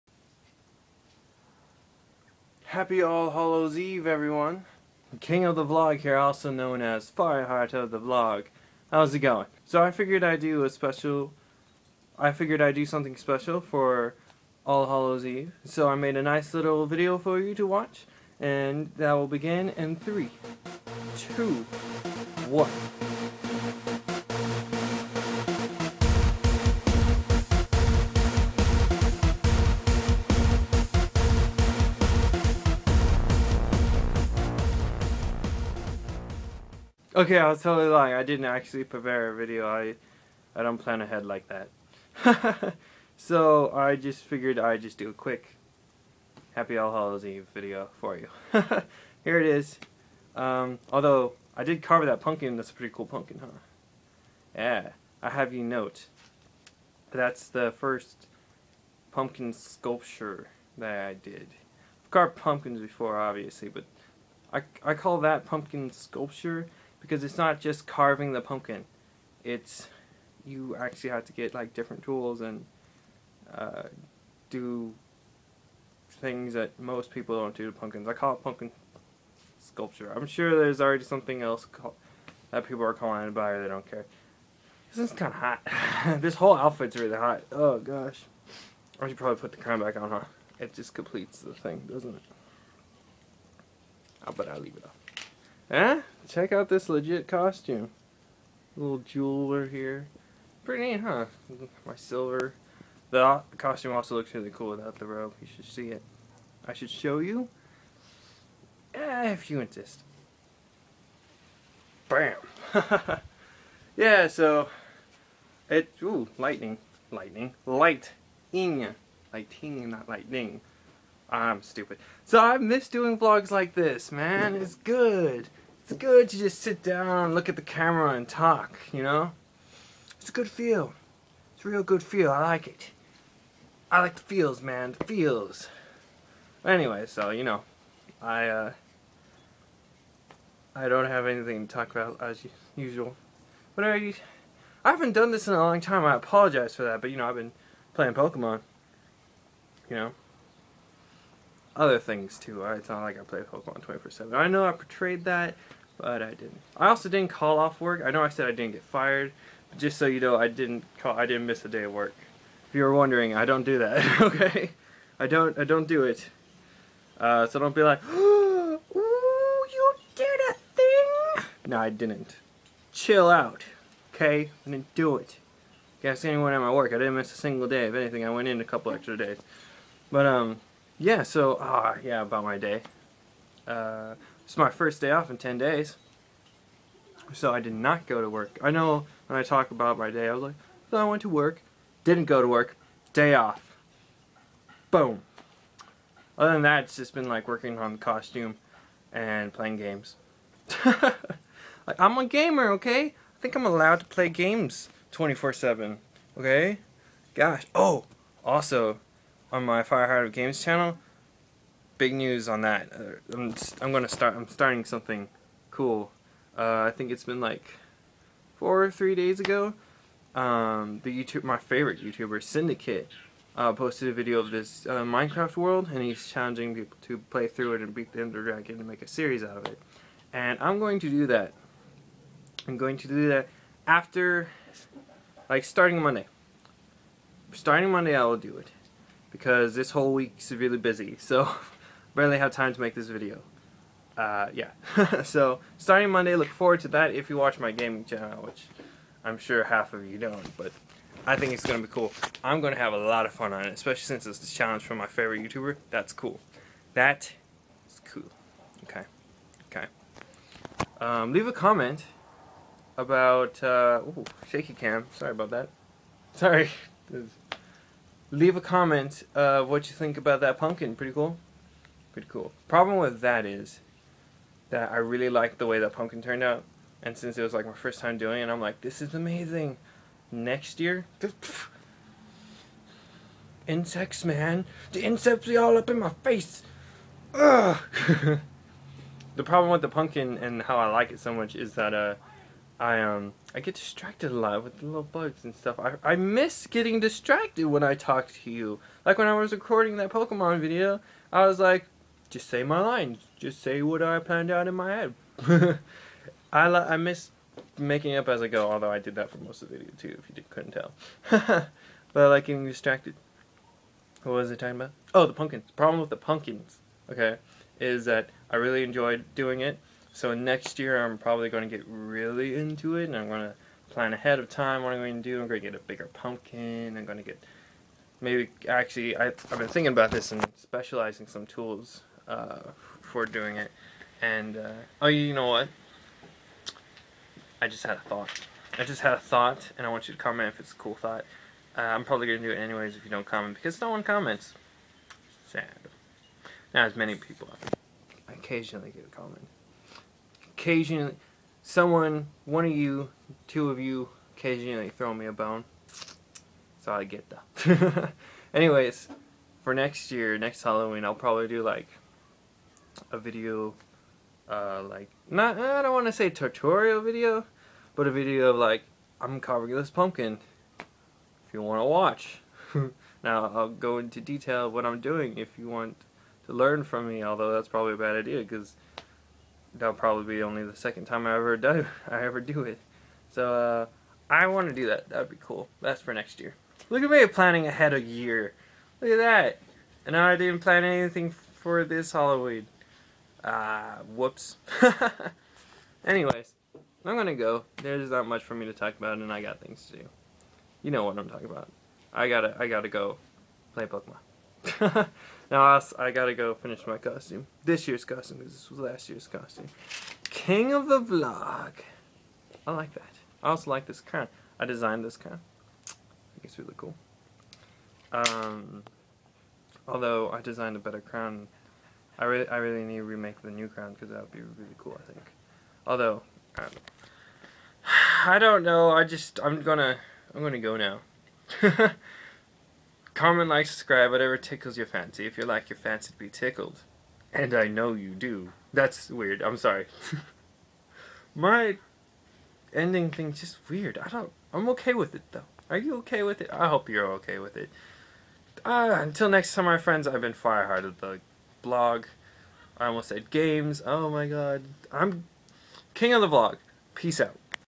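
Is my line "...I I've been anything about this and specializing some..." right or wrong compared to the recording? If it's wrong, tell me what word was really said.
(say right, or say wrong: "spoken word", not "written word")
wrong: "thinking", not "anything".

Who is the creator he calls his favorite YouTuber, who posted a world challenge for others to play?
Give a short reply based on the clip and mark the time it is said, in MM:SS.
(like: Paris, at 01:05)
Syndicate, at 03:42.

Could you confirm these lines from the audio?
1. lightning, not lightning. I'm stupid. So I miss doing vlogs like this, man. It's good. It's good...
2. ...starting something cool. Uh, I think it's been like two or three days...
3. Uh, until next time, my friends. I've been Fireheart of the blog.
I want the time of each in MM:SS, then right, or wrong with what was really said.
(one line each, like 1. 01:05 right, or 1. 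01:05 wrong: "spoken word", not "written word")
1. 01:59 right
2. 03:34 wrong: "four", not "two"
3. 07:28 right.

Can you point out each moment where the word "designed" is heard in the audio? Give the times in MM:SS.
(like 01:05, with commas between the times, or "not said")
06:54, 07:00.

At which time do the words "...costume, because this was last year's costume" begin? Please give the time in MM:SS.
06:48.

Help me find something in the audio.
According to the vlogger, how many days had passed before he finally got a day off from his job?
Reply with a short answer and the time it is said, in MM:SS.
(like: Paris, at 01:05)
10, at 03:05.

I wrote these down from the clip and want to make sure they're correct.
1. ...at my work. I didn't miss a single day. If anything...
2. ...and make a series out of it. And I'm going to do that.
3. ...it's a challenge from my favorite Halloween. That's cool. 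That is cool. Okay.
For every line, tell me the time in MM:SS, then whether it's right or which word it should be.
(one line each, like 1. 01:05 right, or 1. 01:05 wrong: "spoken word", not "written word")
1. 02:56 right
2. 03:48 right
3. 04:14 wrong: "YouTuber", not "Halloween".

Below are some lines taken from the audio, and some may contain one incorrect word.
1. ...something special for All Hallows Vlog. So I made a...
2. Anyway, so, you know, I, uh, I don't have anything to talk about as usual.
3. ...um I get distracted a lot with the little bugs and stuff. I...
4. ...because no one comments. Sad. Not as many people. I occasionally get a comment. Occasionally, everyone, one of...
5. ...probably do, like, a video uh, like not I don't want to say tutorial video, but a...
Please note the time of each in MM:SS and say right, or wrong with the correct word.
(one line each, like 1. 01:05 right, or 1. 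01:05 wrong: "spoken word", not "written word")
1. 00:12 wrong: "Eve", not "Vlog"
2. 02:16 right
3. 04:53 right
4. 05:43 wrong: "someone", not "everyone"
5. 06:01 right.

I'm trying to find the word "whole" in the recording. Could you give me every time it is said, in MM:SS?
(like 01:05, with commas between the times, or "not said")
01:26, 03:59.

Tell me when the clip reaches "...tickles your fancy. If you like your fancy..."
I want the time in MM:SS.
07:14.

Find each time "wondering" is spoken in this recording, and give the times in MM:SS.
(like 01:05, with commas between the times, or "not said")
02:42.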